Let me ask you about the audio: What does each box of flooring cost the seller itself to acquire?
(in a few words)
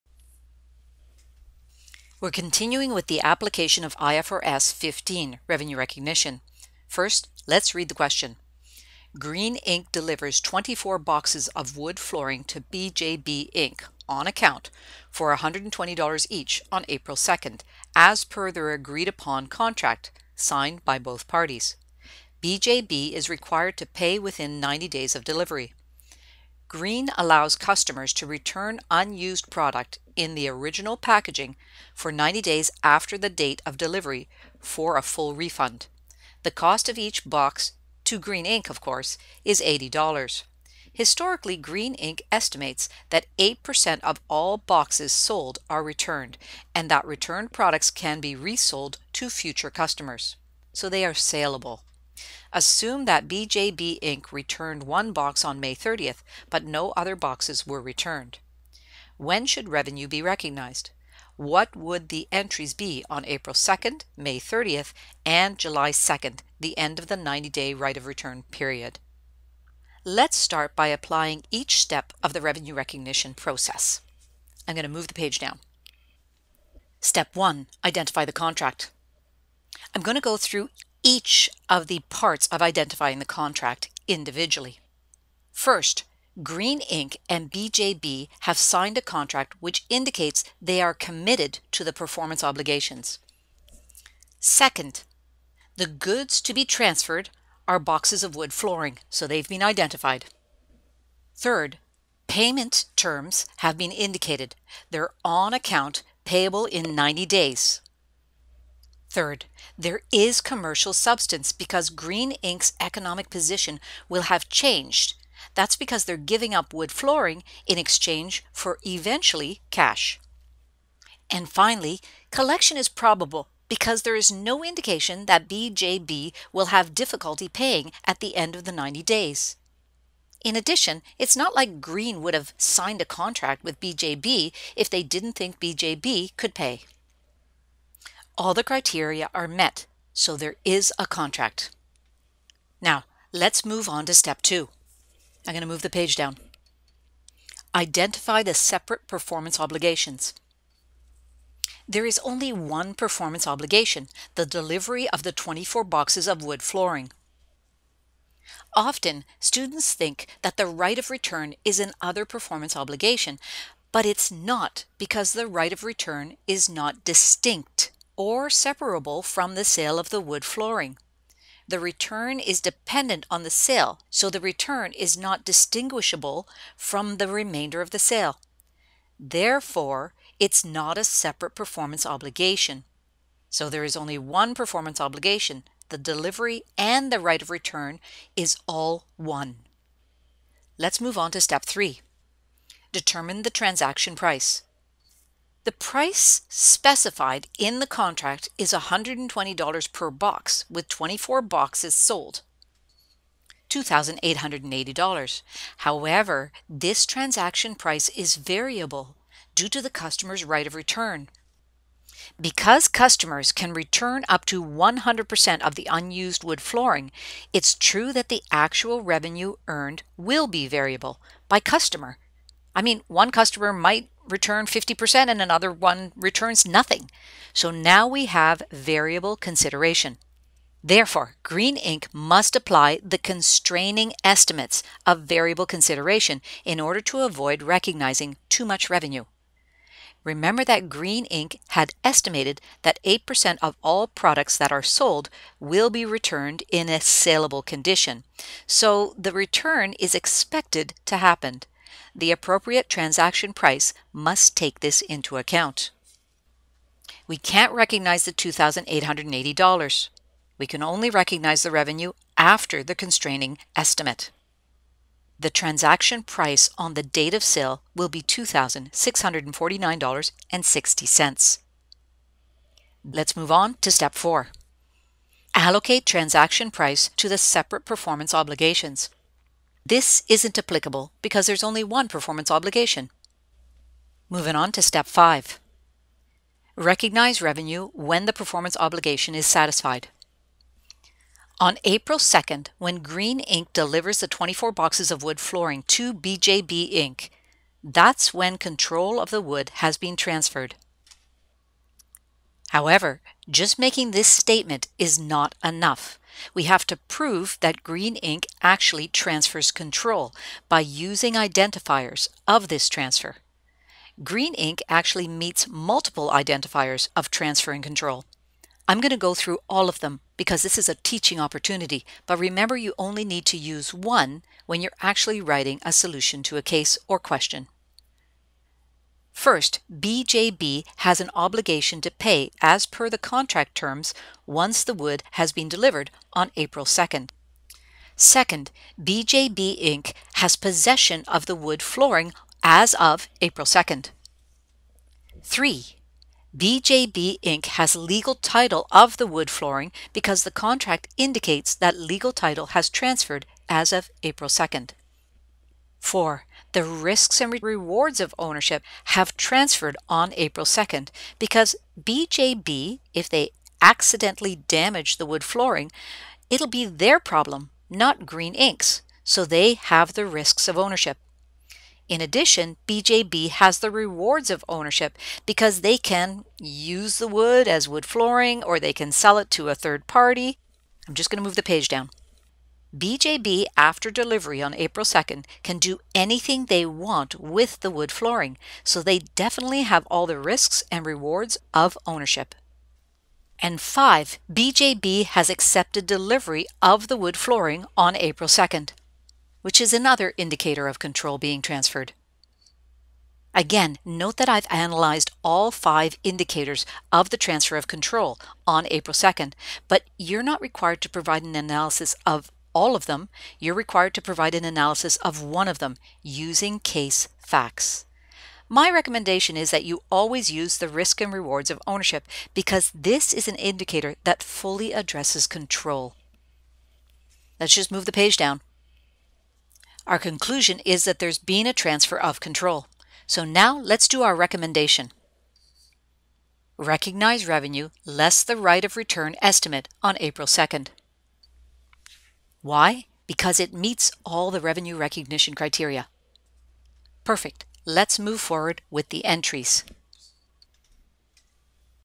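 $80.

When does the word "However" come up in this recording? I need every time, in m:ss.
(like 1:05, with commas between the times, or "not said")
3:25, 5:02.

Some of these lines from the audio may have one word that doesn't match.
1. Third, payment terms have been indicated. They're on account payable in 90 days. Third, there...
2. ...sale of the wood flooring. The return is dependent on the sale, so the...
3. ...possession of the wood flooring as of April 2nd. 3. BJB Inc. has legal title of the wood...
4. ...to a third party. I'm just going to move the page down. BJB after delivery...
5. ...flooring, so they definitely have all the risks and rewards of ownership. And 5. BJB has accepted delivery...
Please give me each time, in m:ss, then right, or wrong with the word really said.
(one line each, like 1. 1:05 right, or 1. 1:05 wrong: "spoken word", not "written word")
1. 1:41 right
2. 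2:49 right
3. 5:40 right
4. 6:19 right
5. 6:28 right.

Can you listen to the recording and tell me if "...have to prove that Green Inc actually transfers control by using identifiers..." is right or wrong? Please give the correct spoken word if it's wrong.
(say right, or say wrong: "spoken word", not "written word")
right.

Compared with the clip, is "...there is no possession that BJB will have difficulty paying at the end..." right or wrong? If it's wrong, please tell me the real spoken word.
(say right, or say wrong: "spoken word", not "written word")
wrong: "indication", not "possession".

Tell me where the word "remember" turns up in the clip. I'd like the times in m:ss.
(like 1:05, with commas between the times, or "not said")
4:00, 5:22.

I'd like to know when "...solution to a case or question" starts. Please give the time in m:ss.
5:25.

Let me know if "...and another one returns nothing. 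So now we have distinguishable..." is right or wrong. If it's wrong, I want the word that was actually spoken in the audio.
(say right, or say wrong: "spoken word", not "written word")
wrong: "variable", not "distinguishable".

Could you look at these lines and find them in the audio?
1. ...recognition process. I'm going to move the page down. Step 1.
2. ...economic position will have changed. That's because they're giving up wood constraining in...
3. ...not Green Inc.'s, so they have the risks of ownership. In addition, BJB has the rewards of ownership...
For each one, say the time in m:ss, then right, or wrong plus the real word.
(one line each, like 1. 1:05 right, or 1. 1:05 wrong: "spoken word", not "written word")
1. 1:12 right
2. 1:52 wrong: "flooring", not "constraining"
3. 6:07 right.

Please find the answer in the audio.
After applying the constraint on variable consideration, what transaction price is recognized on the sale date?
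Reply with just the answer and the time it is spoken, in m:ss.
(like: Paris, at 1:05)
$2,649.60, at 4:28.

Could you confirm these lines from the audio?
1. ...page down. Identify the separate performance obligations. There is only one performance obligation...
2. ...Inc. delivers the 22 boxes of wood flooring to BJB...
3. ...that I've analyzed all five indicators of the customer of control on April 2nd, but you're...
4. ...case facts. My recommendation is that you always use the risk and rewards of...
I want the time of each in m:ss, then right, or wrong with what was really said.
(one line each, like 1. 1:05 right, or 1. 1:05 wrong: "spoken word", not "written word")
1. 2:25 right
2. 4:53 wrong: "24", not "22"
3. 6:44 wrong: "transfer", not "customer"
4. 6:56 right.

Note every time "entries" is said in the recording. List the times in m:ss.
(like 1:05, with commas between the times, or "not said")
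1:02, 7:29.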